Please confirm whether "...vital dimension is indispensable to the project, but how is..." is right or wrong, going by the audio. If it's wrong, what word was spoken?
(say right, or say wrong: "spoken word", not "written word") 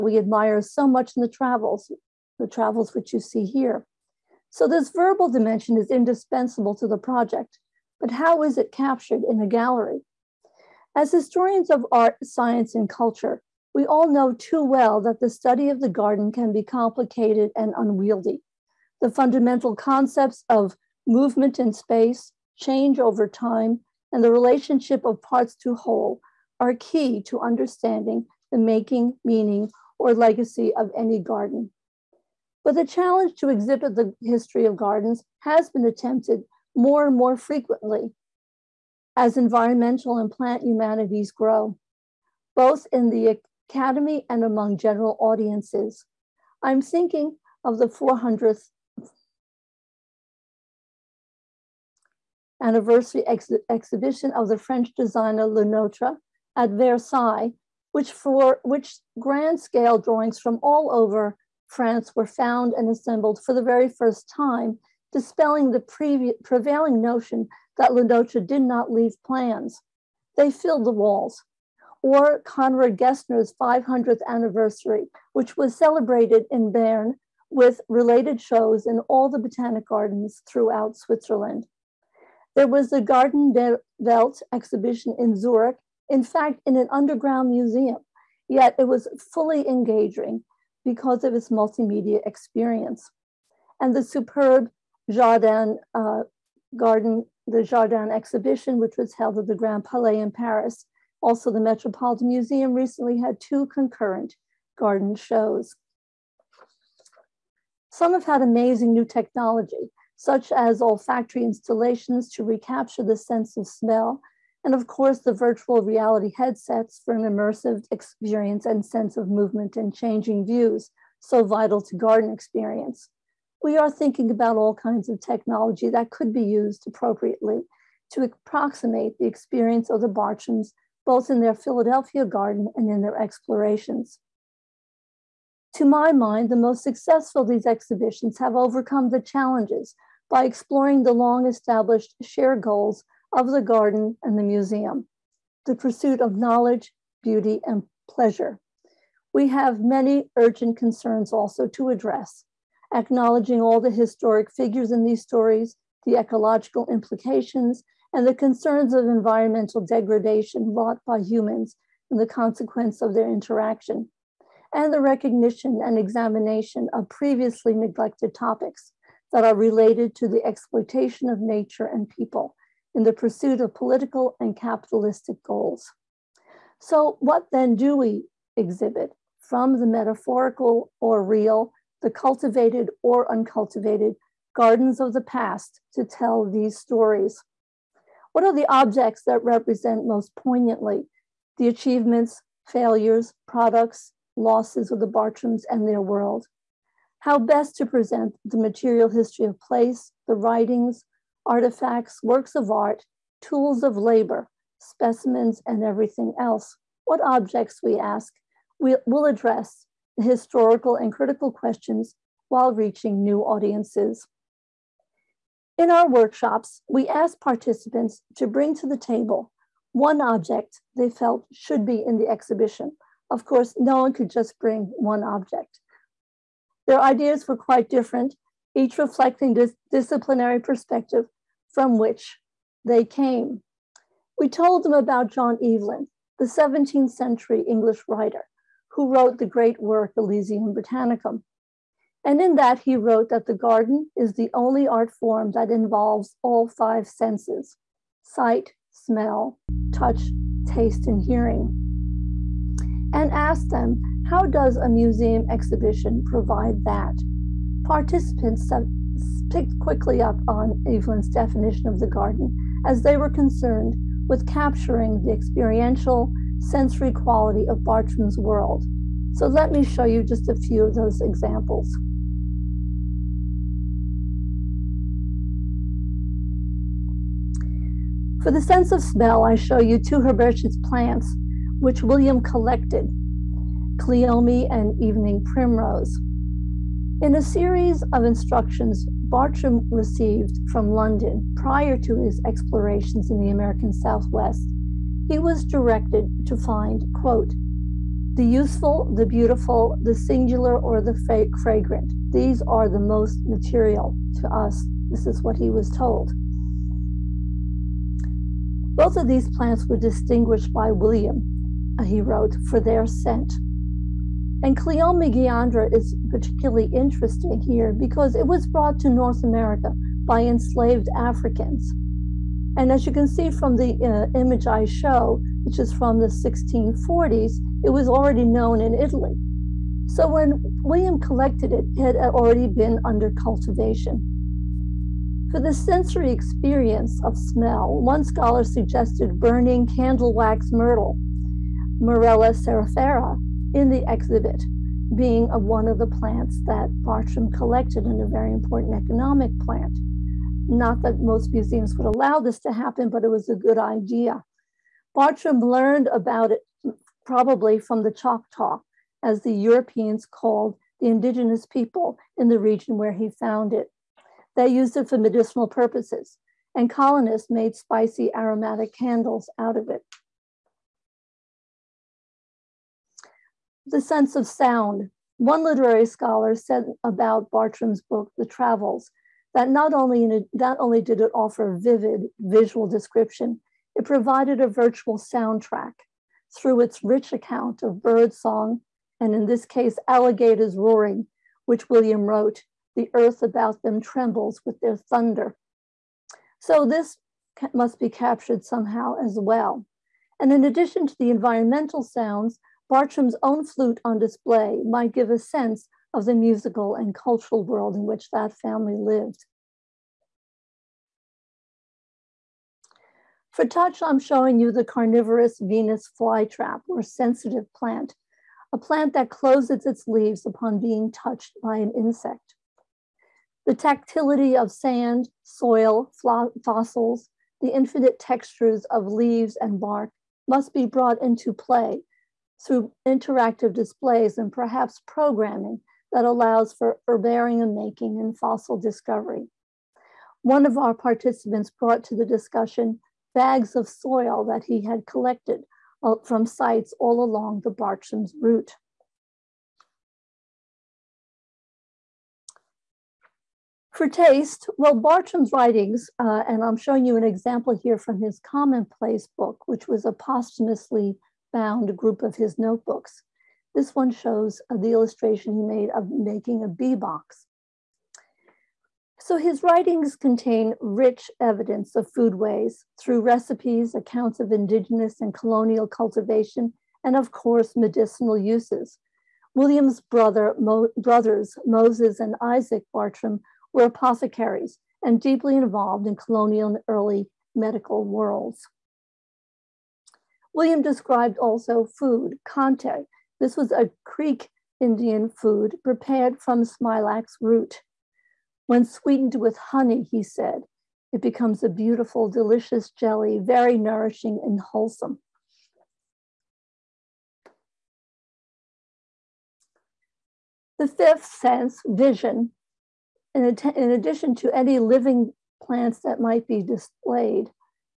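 wrong: "verbal", not "vital".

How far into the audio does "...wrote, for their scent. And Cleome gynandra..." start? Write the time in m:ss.
5:12.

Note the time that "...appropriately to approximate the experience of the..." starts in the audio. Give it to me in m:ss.
2:06.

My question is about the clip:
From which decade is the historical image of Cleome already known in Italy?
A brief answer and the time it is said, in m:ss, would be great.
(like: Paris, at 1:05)
1640s, at 5:26.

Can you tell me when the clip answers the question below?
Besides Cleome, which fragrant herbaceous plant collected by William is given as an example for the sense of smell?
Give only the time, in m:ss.
4:44.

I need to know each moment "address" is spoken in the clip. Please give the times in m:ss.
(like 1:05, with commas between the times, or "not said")
2:31, 3:29.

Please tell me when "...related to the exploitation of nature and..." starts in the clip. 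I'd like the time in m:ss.
2:49.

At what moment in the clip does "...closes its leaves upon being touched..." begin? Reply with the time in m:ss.
6:59.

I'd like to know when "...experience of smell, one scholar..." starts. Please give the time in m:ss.
5:36.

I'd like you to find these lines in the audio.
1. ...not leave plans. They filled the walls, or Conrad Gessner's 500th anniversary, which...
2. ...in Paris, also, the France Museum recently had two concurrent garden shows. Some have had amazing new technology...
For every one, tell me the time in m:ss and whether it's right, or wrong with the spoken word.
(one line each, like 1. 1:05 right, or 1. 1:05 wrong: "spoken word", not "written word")
1. 1:08 right
2. 1:40 wrong: "Metropolitan", not "France".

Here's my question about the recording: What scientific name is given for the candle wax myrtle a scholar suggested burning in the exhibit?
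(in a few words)
Morella cerifera.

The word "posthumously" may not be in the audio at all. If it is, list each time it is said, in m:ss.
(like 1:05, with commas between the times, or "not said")
7:40.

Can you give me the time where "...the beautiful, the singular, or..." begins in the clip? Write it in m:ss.
4:59.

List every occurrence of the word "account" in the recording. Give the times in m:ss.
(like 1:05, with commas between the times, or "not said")
6:27, 7:53.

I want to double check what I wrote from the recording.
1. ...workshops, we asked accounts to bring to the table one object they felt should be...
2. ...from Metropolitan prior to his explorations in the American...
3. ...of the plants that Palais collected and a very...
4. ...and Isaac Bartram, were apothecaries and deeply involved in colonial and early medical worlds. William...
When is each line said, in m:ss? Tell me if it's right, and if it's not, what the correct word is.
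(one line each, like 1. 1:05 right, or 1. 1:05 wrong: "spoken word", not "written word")
1. 3:36 wrong: "participants", not "accounts"
2. 4:50 wrong: "London", not "Metropolitan"
3. 5:45 wrong: "Bartram", not "Palais"
4. 8:02 right.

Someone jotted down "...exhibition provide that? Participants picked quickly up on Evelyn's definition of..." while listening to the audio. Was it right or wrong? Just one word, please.
right.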